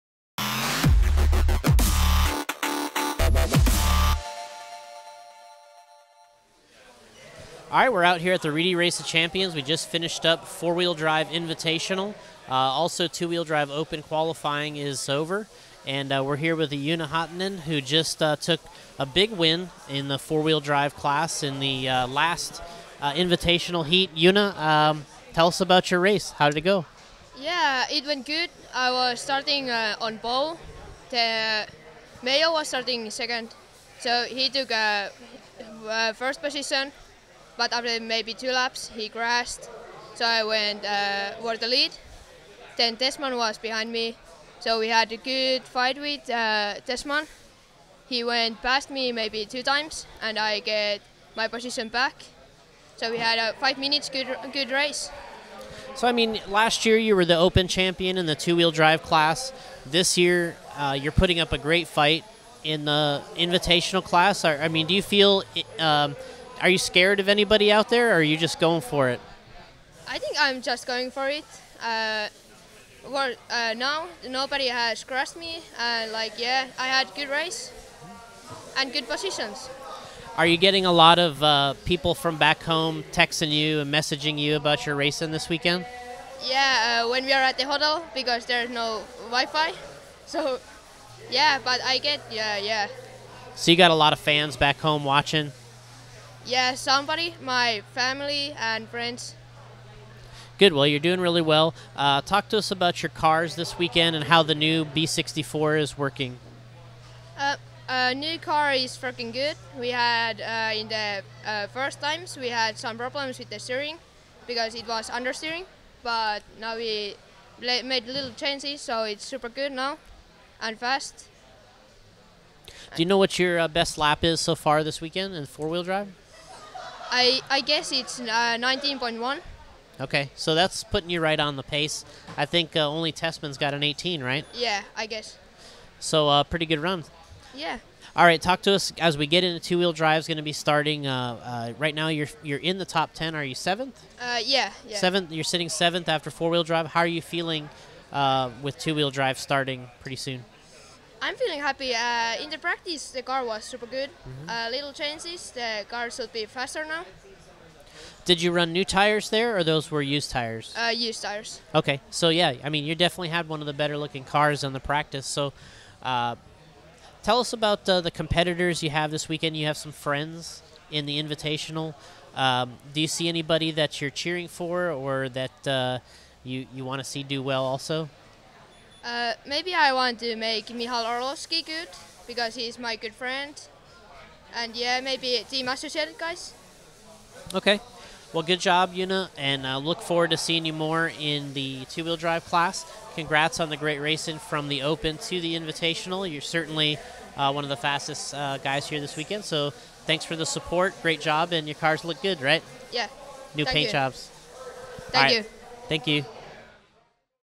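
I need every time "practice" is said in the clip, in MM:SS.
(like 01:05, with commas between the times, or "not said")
02:32, 02:44.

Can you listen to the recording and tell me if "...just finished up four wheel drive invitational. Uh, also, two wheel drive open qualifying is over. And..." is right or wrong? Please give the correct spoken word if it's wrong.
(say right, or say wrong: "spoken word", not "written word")
right.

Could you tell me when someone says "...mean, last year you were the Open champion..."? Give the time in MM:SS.
00:56.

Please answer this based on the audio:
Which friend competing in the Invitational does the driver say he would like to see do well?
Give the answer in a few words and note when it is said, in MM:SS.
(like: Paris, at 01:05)
Michal Orlovsky, at 03:00.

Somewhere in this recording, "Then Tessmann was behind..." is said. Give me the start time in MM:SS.
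00:42.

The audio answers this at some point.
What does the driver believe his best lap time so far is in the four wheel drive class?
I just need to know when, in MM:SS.
02:08.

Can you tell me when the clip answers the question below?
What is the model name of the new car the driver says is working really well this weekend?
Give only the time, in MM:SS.
01:44.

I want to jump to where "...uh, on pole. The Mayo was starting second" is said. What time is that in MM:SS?
00:29.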